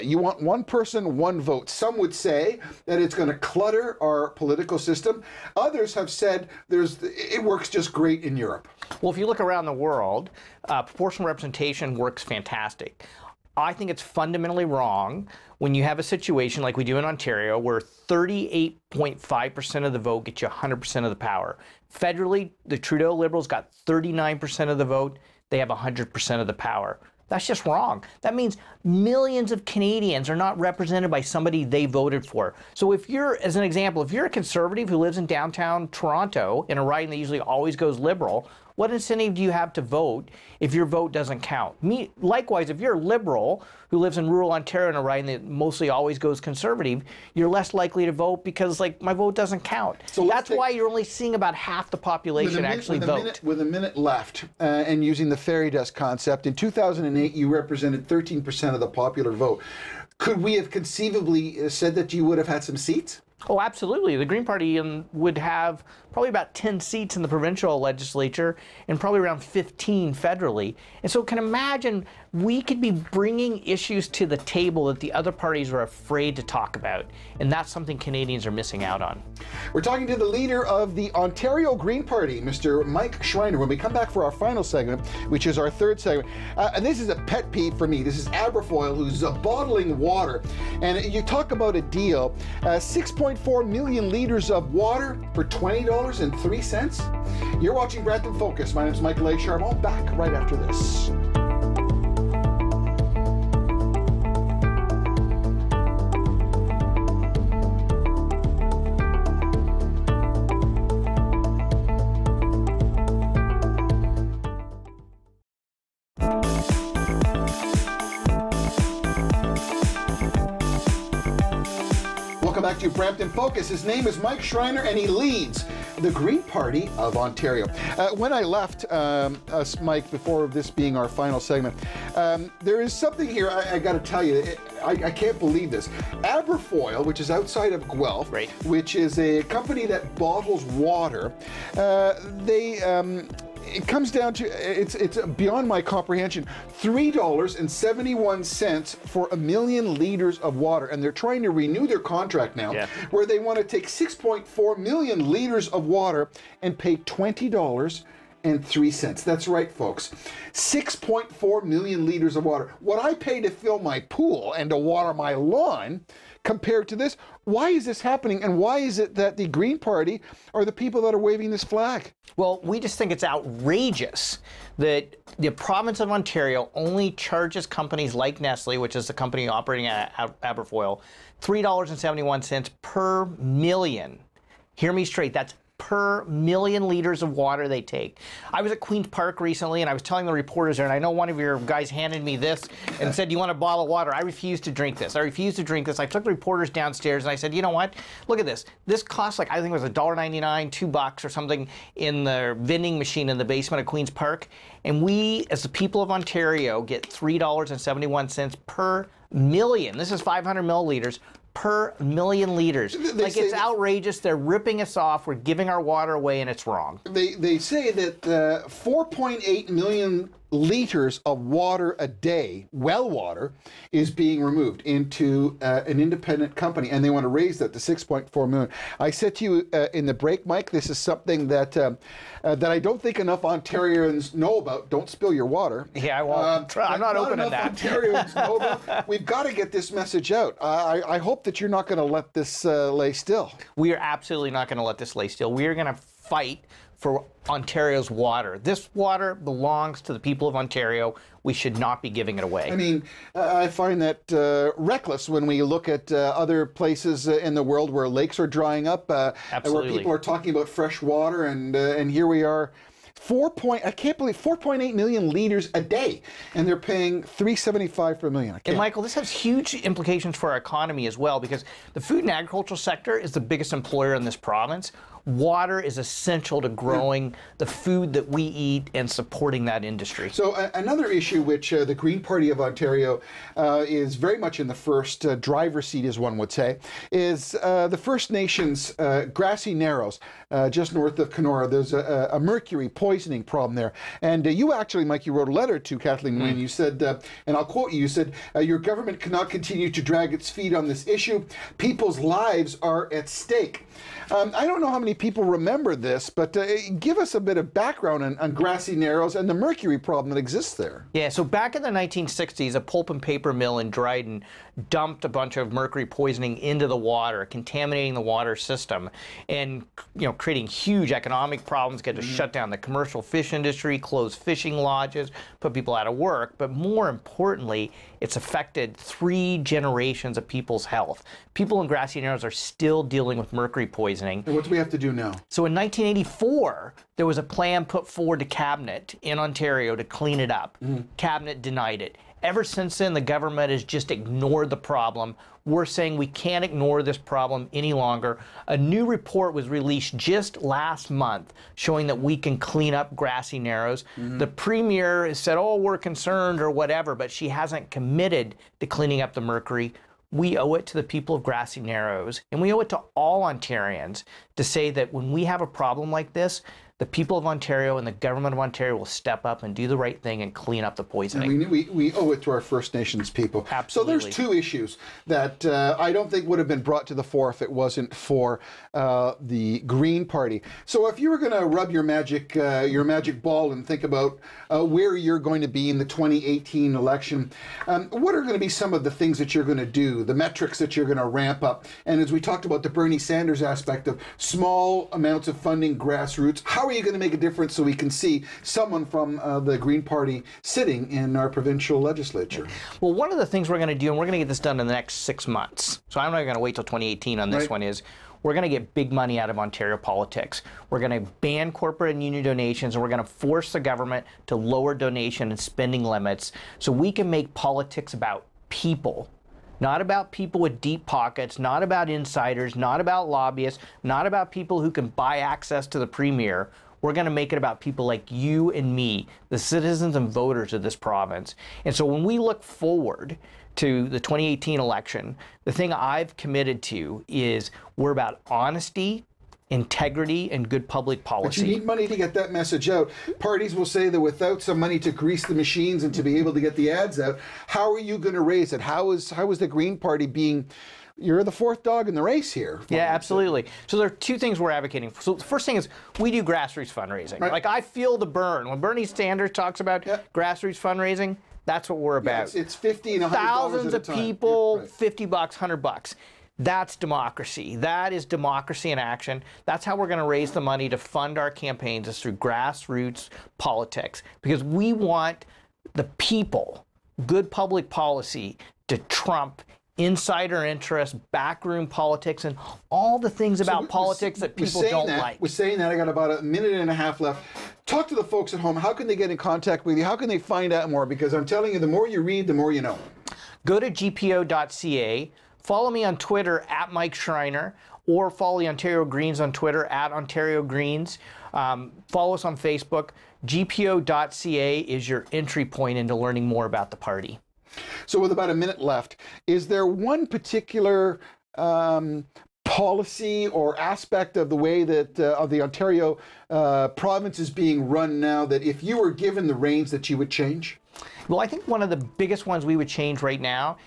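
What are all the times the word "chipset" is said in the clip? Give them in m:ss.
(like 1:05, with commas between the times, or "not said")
not said.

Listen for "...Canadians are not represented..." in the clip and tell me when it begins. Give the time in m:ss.
0:29.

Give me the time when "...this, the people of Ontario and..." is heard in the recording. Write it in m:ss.
6:06.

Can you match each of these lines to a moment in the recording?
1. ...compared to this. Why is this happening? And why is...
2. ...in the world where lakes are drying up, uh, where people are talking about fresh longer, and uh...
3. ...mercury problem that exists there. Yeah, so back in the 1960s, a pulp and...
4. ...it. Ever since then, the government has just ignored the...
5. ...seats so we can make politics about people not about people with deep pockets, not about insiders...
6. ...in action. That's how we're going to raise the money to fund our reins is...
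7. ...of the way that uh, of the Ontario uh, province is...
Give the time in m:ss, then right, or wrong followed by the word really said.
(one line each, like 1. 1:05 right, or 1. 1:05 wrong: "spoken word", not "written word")
1. 2:46 right
2. 4:17 wrong: "water", not "longer"
3. 5:09 right
4. 5:42 right
5. 6:56 wrong: "limits", not "seats"
6. 7:48 wrong: "campaigns", not "reins"
7. 8:34 right.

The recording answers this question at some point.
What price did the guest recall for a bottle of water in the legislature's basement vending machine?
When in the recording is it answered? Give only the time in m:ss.
3:19.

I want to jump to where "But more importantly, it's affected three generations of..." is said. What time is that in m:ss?
5:26.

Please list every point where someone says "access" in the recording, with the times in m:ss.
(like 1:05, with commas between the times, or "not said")
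7:05.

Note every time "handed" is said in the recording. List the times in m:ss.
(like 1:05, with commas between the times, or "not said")
3:11.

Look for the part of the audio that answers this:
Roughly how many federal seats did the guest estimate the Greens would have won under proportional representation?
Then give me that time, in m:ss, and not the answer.
1:09.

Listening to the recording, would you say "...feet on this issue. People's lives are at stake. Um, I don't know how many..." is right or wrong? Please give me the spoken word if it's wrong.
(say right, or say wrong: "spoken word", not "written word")
right.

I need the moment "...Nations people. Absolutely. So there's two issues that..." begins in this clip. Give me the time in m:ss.
6:12.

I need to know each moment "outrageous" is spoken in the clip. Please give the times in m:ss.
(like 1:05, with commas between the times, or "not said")
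2:53, 3:33.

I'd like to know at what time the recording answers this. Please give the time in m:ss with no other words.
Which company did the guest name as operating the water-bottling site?
2:58.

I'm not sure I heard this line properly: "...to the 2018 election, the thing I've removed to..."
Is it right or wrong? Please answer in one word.
wrong.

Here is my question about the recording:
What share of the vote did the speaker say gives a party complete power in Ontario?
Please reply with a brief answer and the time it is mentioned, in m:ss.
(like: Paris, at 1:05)
38.5%, at 0:17.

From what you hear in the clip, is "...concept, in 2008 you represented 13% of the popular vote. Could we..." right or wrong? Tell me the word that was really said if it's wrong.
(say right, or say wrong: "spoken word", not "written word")
right.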